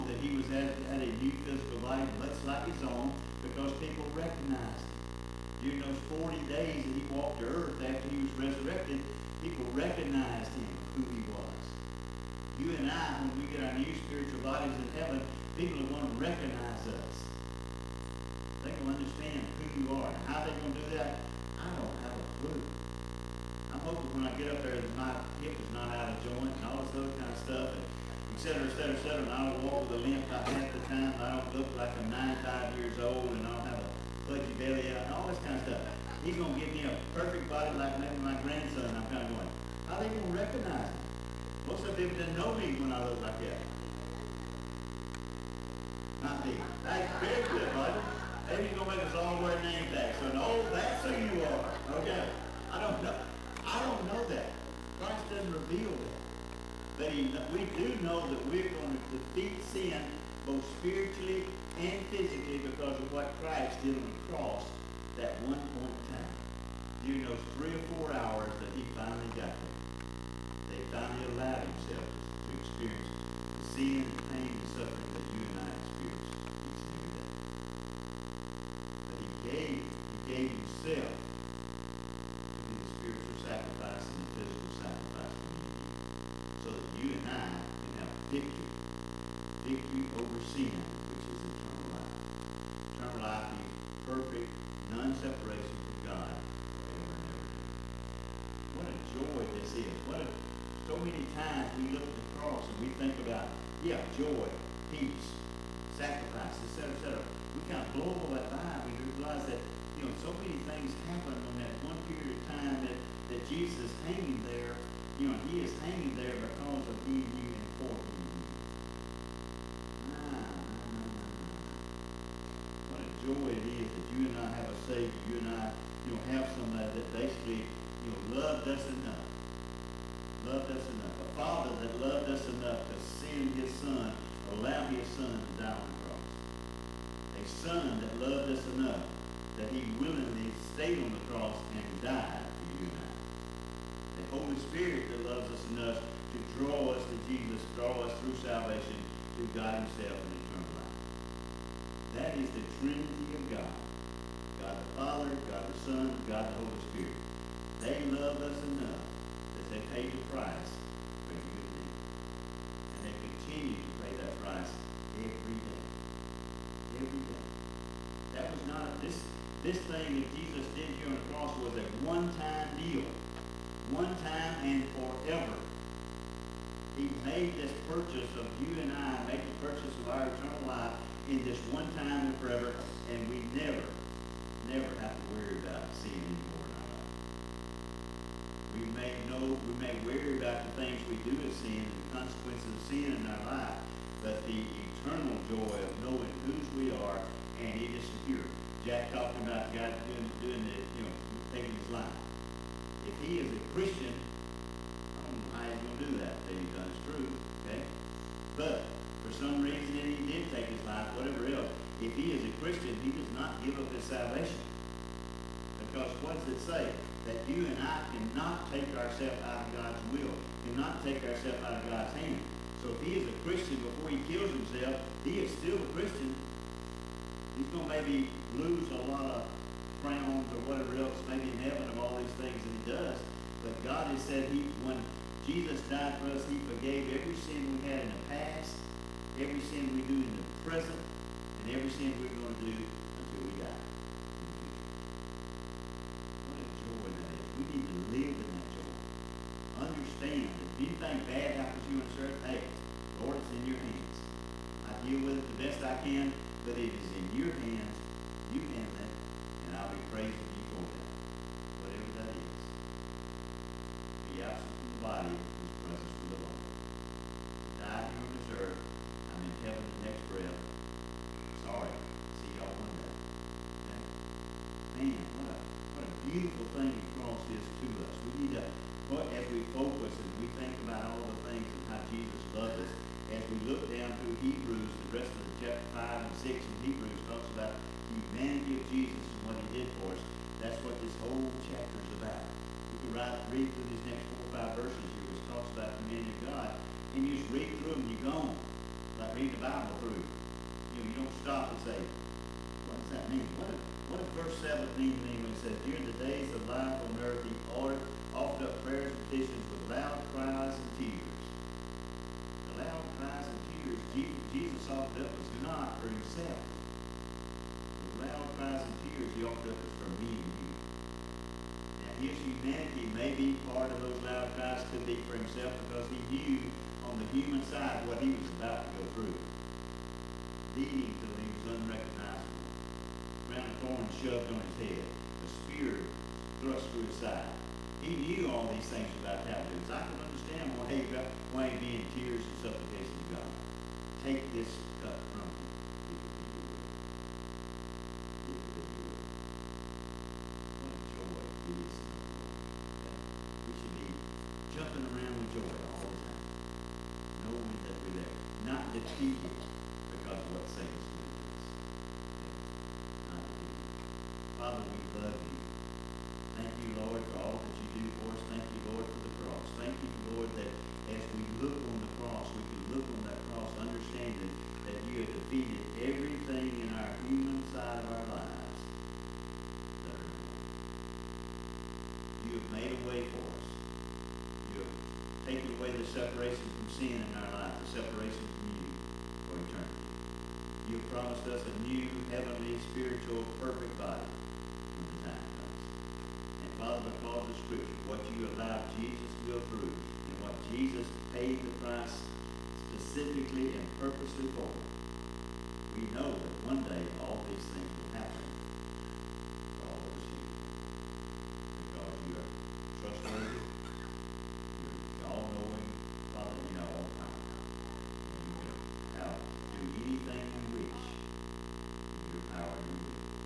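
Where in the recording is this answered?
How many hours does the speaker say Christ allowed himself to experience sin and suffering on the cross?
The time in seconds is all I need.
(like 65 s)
67 s.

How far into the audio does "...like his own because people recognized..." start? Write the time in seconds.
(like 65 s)
2 s.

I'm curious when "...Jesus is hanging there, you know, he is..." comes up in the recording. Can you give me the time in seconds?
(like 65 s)
113 s.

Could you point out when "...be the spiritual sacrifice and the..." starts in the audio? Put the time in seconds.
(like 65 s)
82 s.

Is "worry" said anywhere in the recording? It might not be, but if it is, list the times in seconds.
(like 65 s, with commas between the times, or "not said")
185 s, 190 s.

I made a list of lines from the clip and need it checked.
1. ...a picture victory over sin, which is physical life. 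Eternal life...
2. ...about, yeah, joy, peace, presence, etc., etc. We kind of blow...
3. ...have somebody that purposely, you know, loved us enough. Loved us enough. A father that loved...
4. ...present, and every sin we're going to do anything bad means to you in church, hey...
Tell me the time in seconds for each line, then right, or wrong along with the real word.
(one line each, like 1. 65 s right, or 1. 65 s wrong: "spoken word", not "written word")
1. 88 s wrong: "eternal", not "physical"
2. 103 s wrong: "sacrifice", not "presence"
3. 126 s wrong: "basically", not "purposely"
4. 240 s wrong: "happens", not "means".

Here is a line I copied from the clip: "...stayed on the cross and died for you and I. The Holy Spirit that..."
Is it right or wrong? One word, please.
right.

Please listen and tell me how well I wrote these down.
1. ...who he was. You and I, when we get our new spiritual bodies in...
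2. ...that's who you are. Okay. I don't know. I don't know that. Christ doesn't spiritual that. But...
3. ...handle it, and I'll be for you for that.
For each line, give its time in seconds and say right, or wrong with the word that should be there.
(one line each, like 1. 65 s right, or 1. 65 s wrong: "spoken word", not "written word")
1. 10 s right
2. 50 s wrong: "reveal", not "spiritual"
3. 258 s right.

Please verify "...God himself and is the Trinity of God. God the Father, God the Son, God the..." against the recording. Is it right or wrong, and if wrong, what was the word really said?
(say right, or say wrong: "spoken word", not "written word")
right.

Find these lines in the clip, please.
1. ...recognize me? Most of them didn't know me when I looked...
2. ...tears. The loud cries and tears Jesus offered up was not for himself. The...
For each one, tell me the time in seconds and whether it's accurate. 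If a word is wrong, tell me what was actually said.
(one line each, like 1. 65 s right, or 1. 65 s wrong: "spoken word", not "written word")
1. 40 s right
2. 310 s right.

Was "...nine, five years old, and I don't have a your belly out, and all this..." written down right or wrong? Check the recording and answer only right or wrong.
right.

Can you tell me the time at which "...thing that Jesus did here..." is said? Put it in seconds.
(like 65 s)
169 s.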